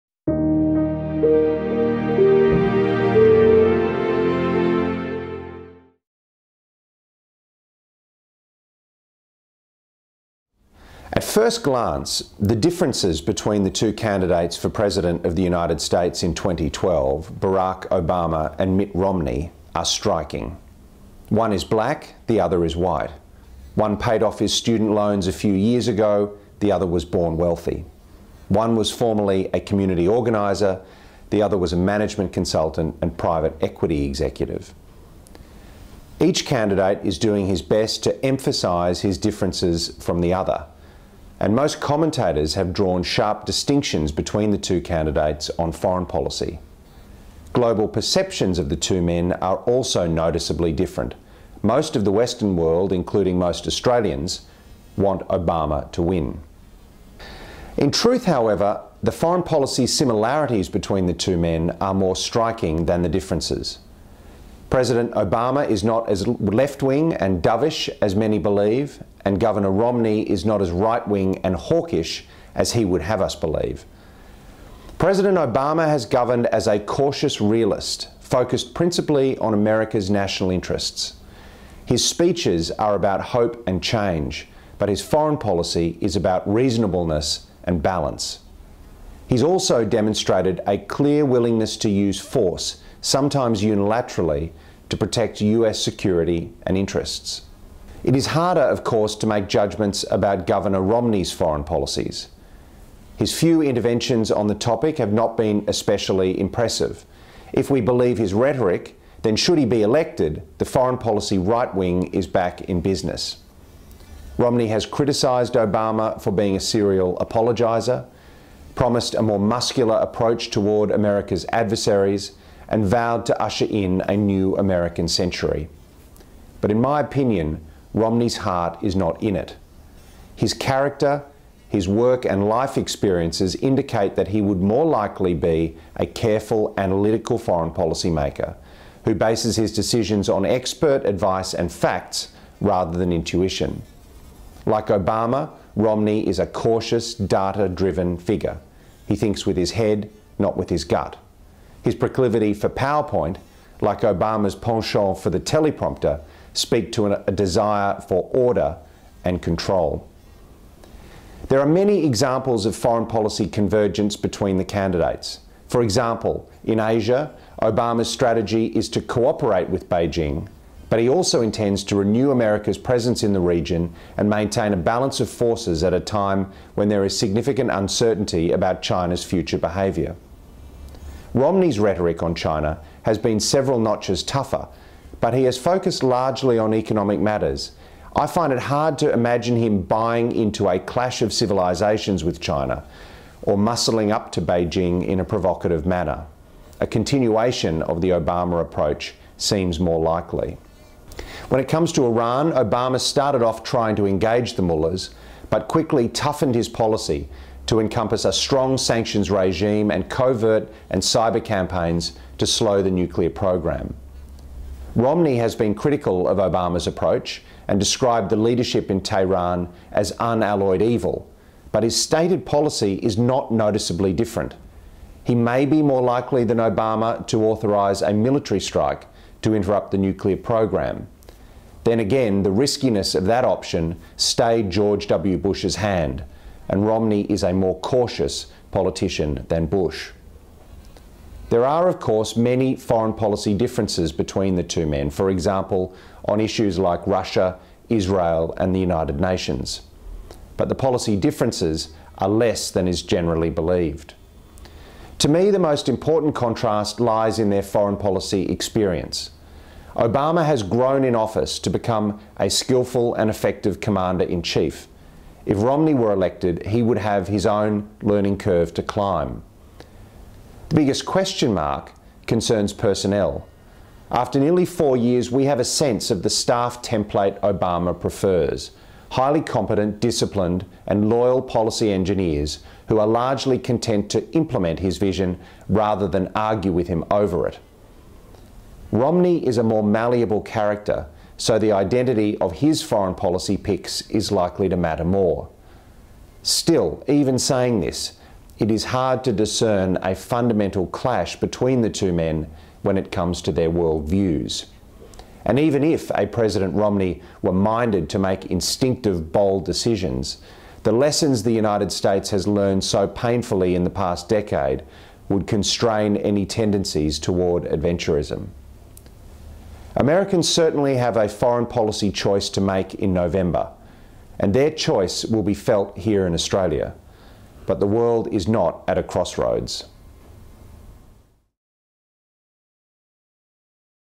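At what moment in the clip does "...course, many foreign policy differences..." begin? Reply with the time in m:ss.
4:01.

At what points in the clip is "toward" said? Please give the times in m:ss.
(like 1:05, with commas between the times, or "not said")
2:00, 5:17.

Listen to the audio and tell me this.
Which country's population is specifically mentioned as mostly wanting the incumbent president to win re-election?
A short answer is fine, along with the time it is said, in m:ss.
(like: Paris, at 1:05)
Australia, at 0:53.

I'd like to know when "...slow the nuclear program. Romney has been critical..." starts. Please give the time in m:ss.
3:32.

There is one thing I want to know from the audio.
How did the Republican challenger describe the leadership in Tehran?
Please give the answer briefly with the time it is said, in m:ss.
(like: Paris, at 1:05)
unalloyed evil, at 3:40.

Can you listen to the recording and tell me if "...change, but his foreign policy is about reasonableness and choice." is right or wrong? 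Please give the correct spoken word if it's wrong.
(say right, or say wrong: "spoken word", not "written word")
wrong: "balance", not "choice".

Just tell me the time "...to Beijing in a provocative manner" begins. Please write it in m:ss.
3:14.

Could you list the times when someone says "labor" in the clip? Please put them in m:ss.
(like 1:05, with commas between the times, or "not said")
not said.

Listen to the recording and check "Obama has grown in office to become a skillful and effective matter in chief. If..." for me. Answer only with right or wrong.
wrong.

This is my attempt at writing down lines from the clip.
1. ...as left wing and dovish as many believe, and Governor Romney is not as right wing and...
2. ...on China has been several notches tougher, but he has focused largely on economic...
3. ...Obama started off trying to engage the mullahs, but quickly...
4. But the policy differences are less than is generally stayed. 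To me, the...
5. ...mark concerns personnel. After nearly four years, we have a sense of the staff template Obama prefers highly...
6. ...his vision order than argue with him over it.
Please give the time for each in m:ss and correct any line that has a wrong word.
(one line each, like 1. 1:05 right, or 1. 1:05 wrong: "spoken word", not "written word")
1. 1:06 right
2. 3:02 right
3. 3:22 right
4. 4:10 wrong: "believed", not "stayed"
5. 4:31 right
6. 4:44 wrong: "rather", not "order".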